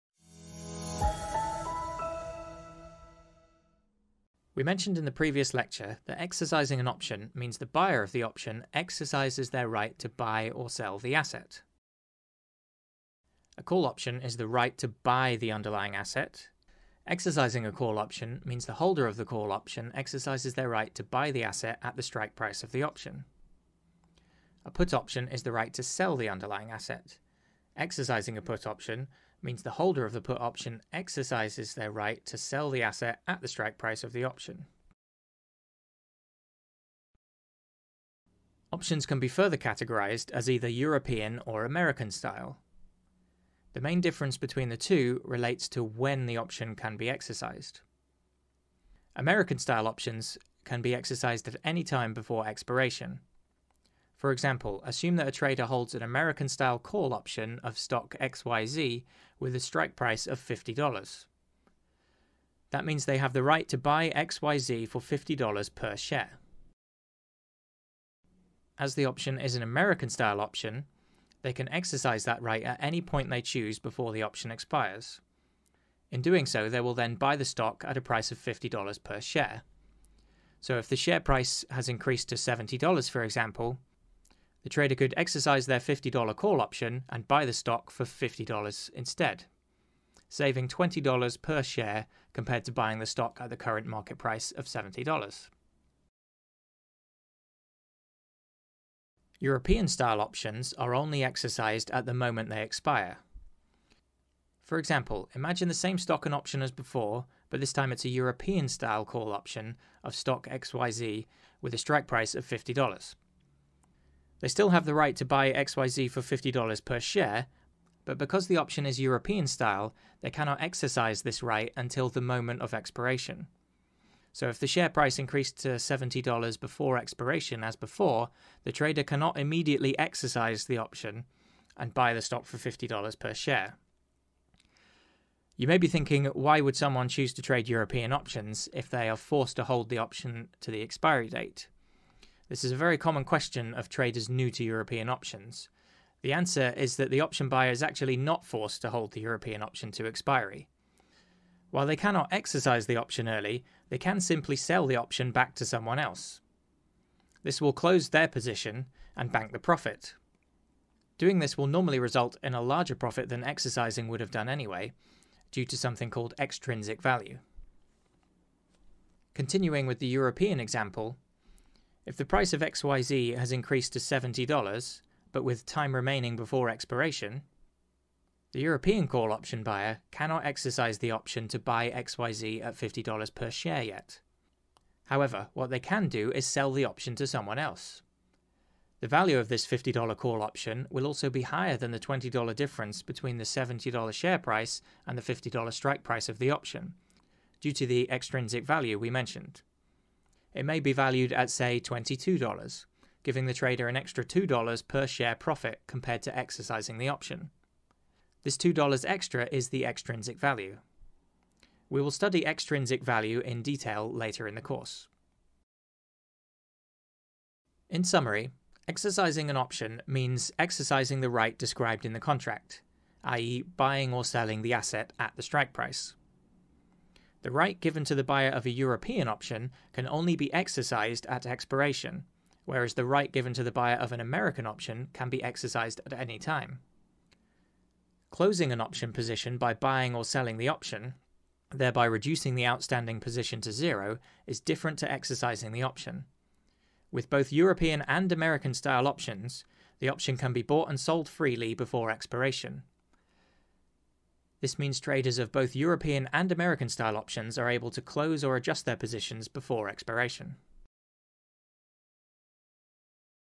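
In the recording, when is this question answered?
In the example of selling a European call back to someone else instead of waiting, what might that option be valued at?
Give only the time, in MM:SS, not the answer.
03:21.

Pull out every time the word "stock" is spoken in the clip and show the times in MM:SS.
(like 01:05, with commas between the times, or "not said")
00:57, 01:17, 01:27, 01:33, 01:45, 01:50, 02:12.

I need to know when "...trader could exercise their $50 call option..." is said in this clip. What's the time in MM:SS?
01:24.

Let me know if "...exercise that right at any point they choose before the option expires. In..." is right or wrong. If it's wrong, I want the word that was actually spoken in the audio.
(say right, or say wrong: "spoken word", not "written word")
right.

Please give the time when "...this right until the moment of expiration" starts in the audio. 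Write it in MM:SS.
02:01.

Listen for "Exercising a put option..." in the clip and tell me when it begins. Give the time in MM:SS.
00:27.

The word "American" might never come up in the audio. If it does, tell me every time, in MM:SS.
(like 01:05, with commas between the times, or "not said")
00:41, 00:49, 00:56, 01:09, 03:54, 04:08, 04:16.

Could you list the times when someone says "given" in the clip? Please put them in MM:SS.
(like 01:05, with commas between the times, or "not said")
03:47, 03:53.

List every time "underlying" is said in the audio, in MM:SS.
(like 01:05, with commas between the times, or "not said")
00:15, 00:26.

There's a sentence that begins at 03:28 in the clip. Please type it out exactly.
This $2 extra is the extrinsic value.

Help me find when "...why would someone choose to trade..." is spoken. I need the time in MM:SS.
02:16.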